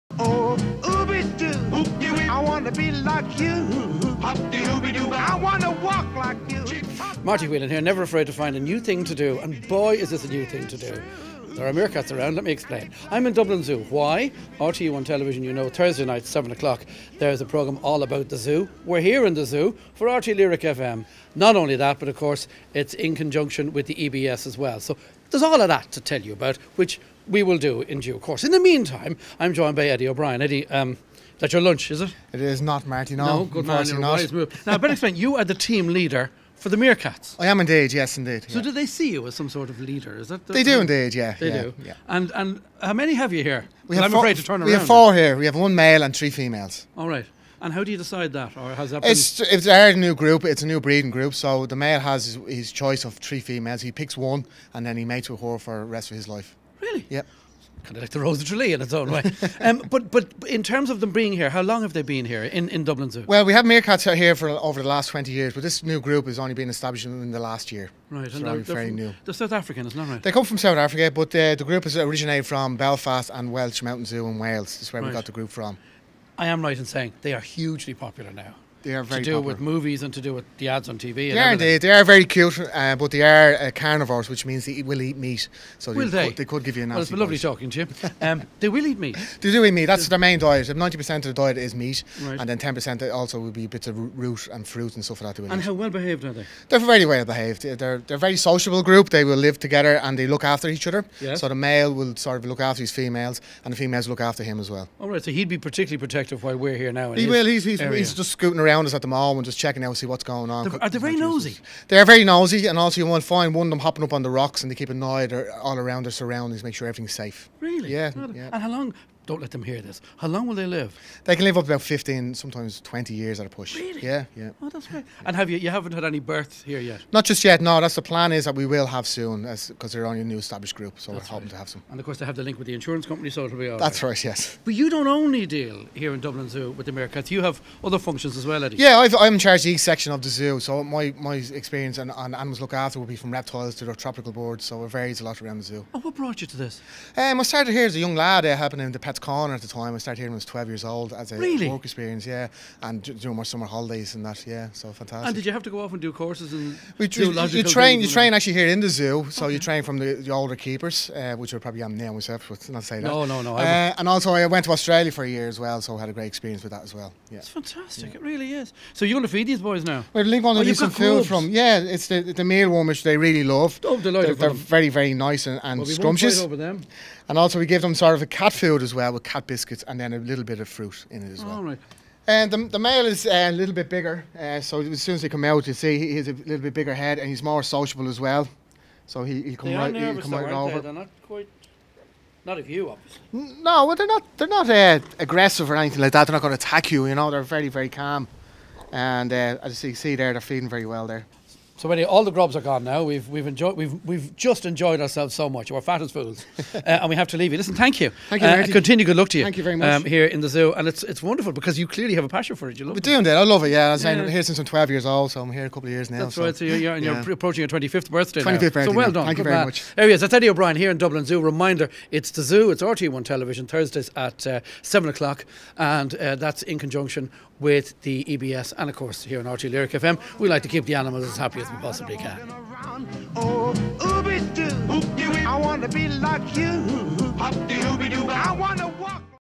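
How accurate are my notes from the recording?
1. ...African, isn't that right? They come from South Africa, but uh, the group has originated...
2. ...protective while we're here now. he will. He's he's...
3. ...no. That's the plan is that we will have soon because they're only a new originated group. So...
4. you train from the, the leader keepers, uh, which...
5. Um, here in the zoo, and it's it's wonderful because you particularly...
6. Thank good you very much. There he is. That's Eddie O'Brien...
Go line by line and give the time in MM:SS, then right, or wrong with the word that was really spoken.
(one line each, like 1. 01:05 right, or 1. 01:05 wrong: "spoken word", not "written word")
1. 01:09 right
2. 01:45 right
3. 02:07 wrong: "established", not "originated"
4. 02:39 wrong: "older", not "leader"
5. 03:29 wrong: "clearly", not "particularly"
6. 03:39 right.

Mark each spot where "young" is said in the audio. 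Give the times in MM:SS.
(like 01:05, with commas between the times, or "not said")
02:27.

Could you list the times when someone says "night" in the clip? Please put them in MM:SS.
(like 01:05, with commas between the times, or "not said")
00:16.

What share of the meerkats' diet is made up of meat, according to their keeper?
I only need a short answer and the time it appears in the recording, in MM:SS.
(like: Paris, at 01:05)
90%, at 01:30.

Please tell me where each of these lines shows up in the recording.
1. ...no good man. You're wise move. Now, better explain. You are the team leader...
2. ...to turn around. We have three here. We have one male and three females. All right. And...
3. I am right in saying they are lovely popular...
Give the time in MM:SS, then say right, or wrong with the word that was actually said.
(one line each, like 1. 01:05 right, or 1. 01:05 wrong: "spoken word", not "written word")
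1. 00:33 right
2. 00:44 wrong: "four", not "three"
3. 01:16 wrong: "hugely", not "lovely".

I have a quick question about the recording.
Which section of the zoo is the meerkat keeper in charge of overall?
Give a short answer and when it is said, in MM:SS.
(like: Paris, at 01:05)
East section, at 02:19.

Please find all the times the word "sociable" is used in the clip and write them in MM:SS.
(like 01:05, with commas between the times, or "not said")
01:38, 03:07.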